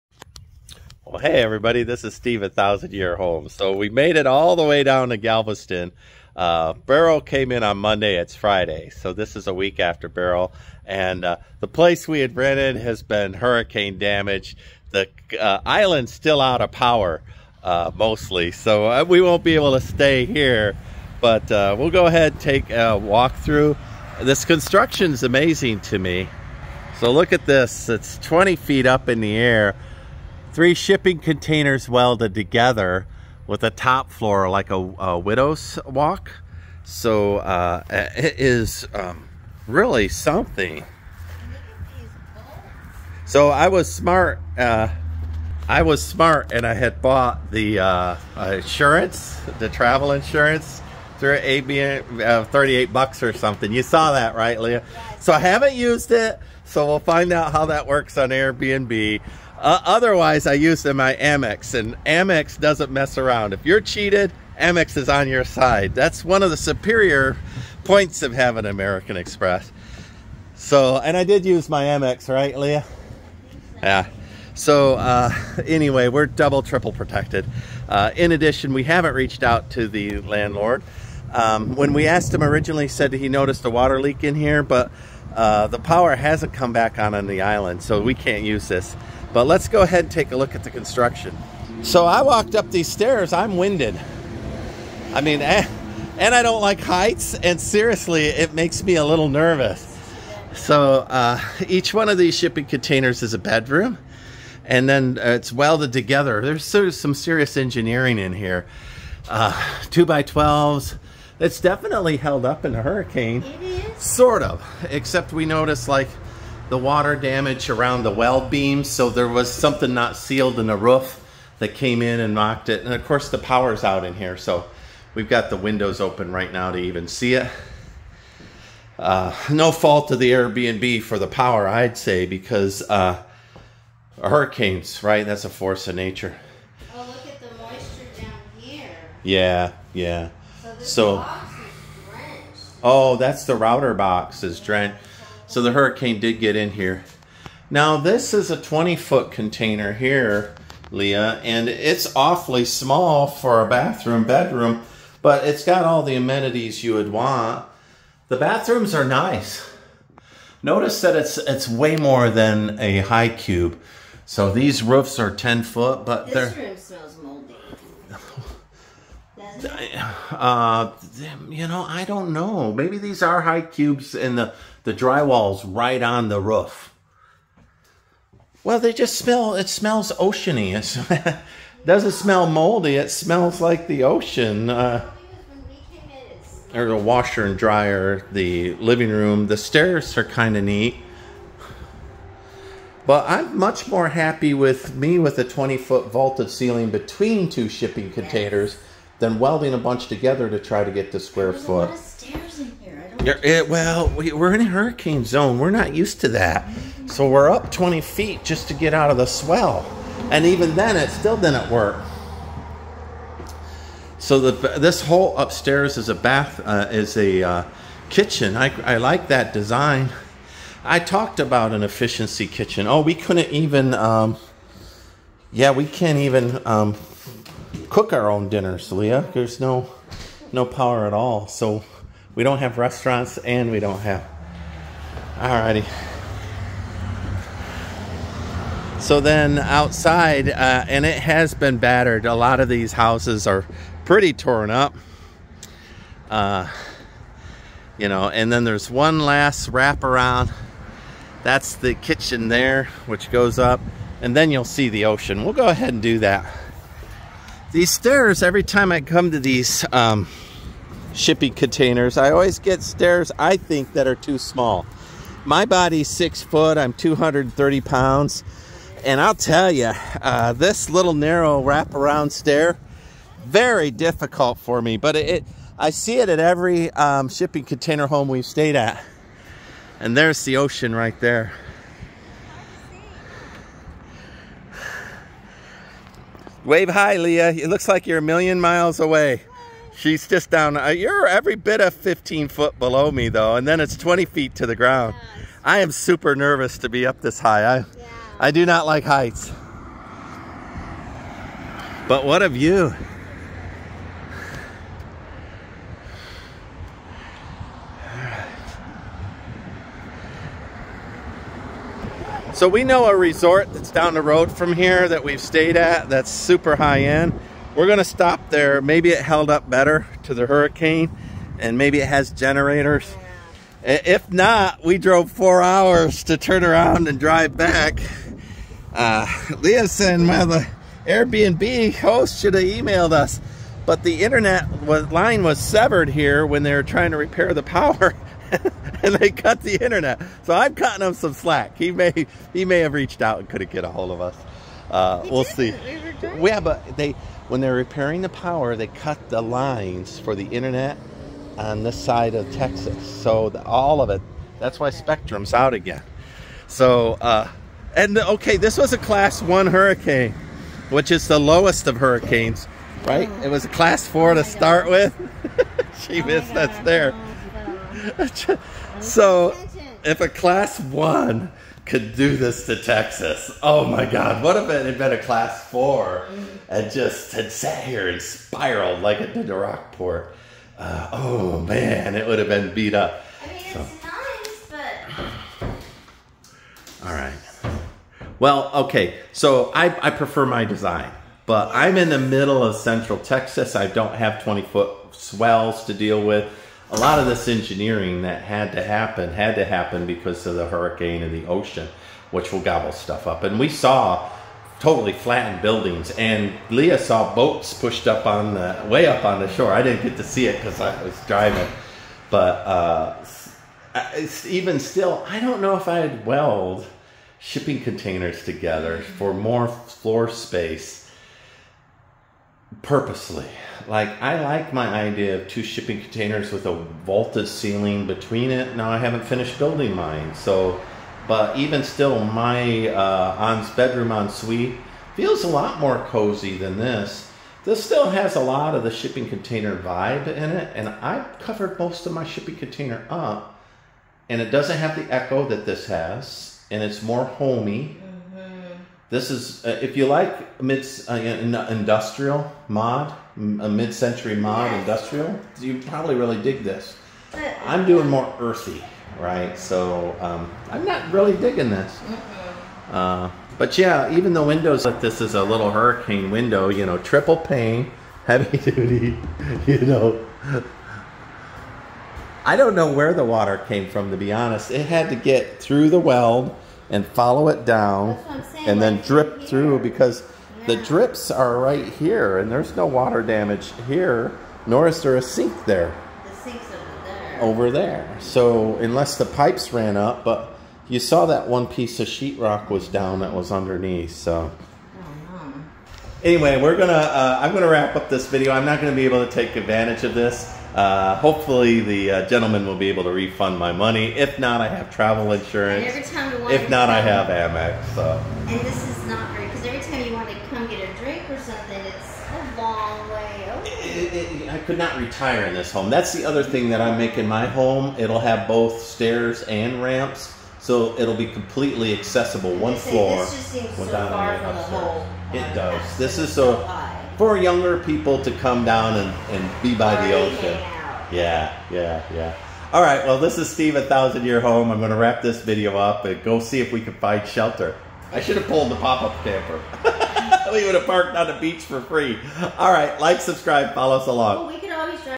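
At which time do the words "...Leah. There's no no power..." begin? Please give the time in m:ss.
3:48.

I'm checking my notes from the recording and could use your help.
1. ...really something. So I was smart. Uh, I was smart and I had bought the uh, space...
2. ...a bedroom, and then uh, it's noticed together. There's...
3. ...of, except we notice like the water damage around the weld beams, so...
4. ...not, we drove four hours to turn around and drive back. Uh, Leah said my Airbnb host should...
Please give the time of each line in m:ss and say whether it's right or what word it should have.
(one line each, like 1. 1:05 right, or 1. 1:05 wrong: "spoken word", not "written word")
1. 0:39 wrong: "insurance", not "space"
2. 1:43 wrong: "welded", not "noticed"
3. 1:54 right
4. 5:24 right.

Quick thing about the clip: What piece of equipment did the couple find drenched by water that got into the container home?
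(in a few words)
router box.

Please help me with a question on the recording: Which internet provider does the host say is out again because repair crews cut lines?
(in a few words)
Spectrum.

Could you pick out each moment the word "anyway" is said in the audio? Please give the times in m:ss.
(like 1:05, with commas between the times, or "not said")
1:15, 8:16.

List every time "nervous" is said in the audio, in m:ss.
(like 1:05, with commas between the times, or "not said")
1:39, 4:56.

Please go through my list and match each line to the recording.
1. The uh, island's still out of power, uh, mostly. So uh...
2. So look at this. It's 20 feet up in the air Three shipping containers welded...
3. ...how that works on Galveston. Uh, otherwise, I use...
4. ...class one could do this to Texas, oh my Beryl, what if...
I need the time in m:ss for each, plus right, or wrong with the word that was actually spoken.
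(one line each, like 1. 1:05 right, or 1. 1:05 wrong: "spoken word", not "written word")
1. 0:14 right
2. 0:26 right
3. 0:57 wrong: "Airbnb", not "Galveston"
4. 6:10 wrong: "God", not "Beryl".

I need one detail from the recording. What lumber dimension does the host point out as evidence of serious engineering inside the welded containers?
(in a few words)
2x12s.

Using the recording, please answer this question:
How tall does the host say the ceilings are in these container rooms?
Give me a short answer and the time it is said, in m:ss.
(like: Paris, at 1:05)
10 feet, at 2:45.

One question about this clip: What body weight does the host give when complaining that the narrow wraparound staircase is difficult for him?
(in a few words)
230 pounds.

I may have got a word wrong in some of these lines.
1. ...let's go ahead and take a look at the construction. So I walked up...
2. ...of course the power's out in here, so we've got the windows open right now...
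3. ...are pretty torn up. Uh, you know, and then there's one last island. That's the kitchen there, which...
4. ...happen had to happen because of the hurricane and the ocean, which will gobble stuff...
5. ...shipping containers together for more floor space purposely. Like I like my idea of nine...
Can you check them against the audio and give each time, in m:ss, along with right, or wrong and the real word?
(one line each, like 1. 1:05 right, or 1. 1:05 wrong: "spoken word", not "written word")
1. 1:29 right
2. 2:02 right
3. 4:03 wrong: "wraparound", not "island"
4. 6:38 right
5. 6:57 wrong: "two", not "nine".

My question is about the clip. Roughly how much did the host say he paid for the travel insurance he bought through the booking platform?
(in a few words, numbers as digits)
$38.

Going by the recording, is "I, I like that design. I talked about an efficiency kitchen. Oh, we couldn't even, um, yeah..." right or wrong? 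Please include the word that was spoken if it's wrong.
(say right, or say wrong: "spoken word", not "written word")
right.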